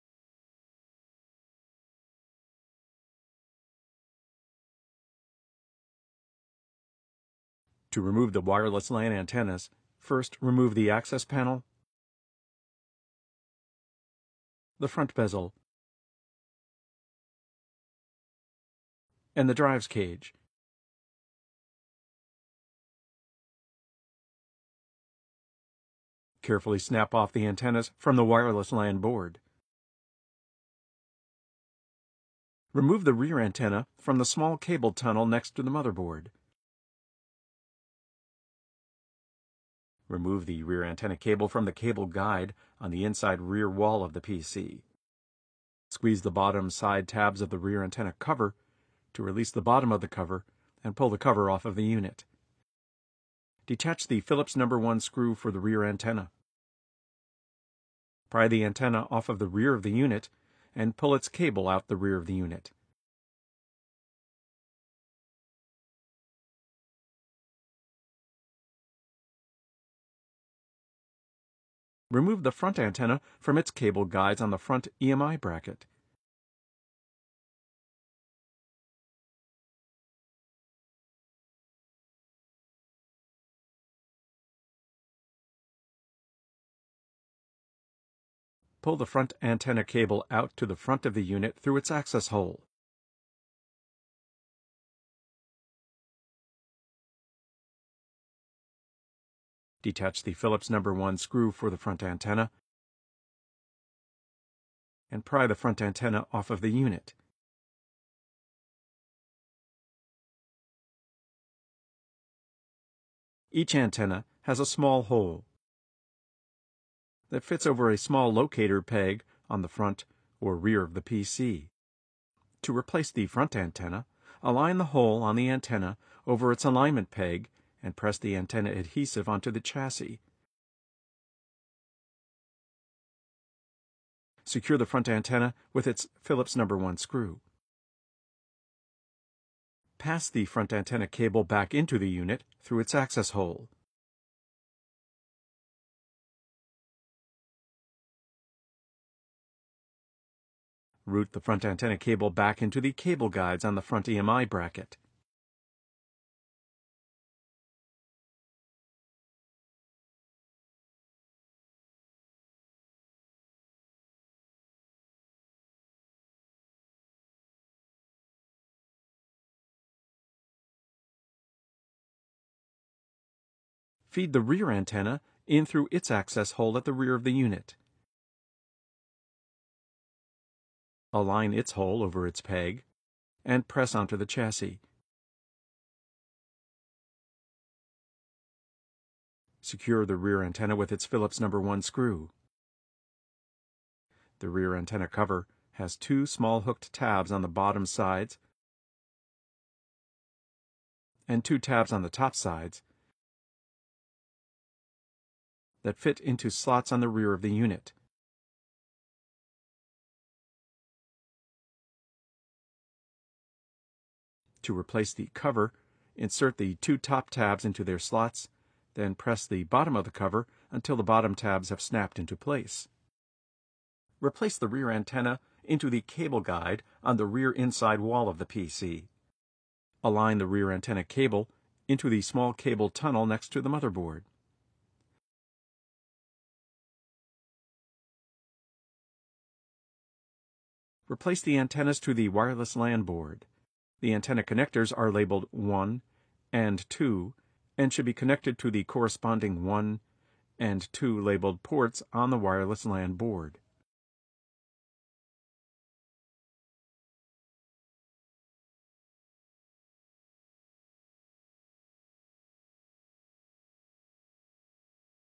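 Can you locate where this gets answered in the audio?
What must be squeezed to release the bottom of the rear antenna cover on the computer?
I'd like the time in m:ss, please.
0:46.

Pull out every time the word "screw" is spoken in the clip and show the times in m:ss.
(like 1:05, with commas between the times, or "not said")
0:54, 1:41, 2:16, 3:11.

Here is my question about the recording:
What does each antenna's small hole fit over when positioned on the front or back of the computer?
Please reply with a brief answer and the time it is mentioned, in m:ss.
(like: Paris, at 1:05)
small locator peg, at 1:57.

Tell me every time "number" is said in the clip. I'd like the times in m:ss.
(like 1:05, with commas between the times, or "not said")
0:54, 1:40, 2:16, 3:11.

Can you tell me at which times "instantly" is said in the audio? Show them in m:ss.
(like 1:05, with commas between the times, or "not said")
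not said.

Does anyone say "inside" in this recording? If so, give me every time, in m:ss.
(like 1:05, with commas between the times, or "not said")
0:43, 3:47.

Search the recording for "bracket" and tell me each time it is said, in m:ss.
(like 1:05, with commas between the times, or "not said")
1:15, 2:34.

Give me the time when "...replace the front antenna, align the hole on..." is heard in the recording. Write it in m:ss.
2:02.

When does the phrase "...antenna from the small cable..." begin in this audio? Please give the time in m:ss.
0:33.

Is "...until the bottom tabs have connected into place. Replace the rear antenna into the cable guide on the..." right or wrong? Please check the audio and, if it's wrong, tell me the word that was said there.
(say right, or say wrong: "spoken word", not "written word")
wrong: "snapped", not "connected".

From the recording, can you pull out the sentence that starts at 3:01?
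Align its hole over its peg, and press onto the chassis.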